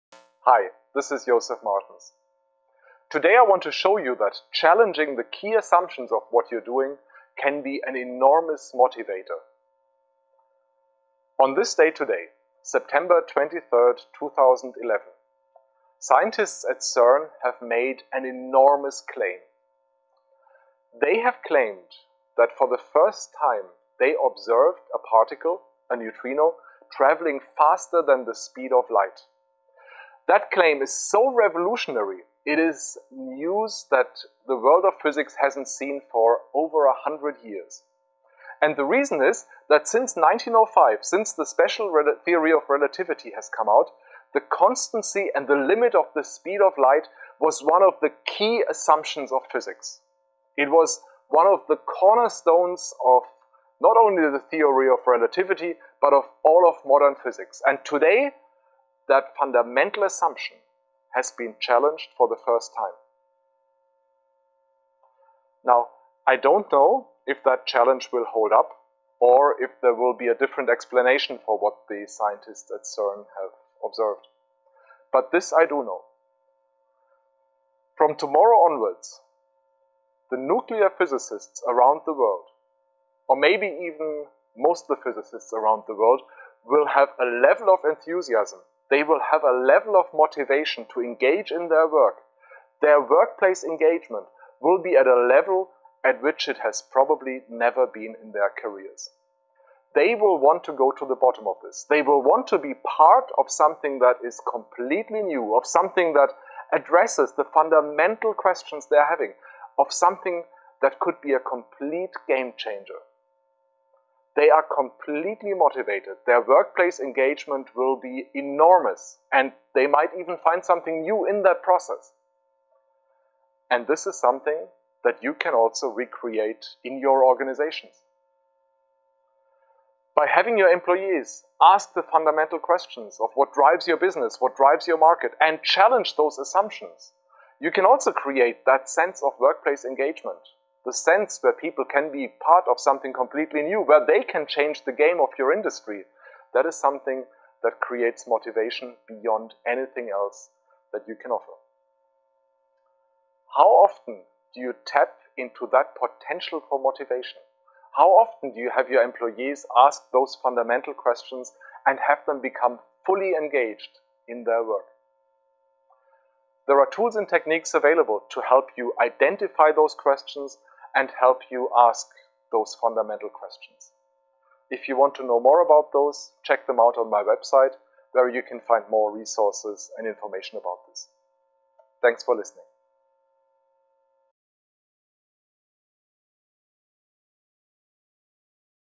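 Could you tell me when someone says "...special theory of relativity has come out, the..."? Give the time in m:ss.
0:41.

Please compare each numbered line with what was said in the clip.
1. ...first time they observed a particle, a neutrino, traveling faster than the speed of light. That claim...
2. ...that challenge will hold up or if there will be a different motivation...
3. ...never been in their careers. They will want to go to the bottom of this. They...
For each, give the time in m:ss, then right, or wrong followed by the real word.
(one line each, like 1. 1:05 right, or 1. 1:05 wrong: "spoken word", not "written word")
1. 0:22 right
2. 1:07 wrong: "explanation", not "motivation"
3. 1:37 right.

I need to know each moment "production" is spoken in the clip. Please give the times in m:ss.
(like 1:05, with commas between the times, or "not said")
not said.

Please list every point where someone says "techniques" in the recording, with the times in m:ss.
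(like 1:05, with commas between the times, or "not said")
2:47.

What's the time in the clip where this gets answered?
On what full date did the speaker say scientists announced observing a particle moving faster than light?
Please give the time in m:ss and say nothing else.
0:12.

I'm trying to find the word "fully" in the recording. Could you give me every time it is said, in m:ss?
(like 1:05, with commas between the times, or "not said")
2:43.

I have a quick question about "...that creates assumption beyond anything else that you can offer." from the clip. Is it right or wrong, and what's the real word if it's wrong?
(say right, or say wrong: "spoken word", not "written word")
wrong: "motivation", not "assumption".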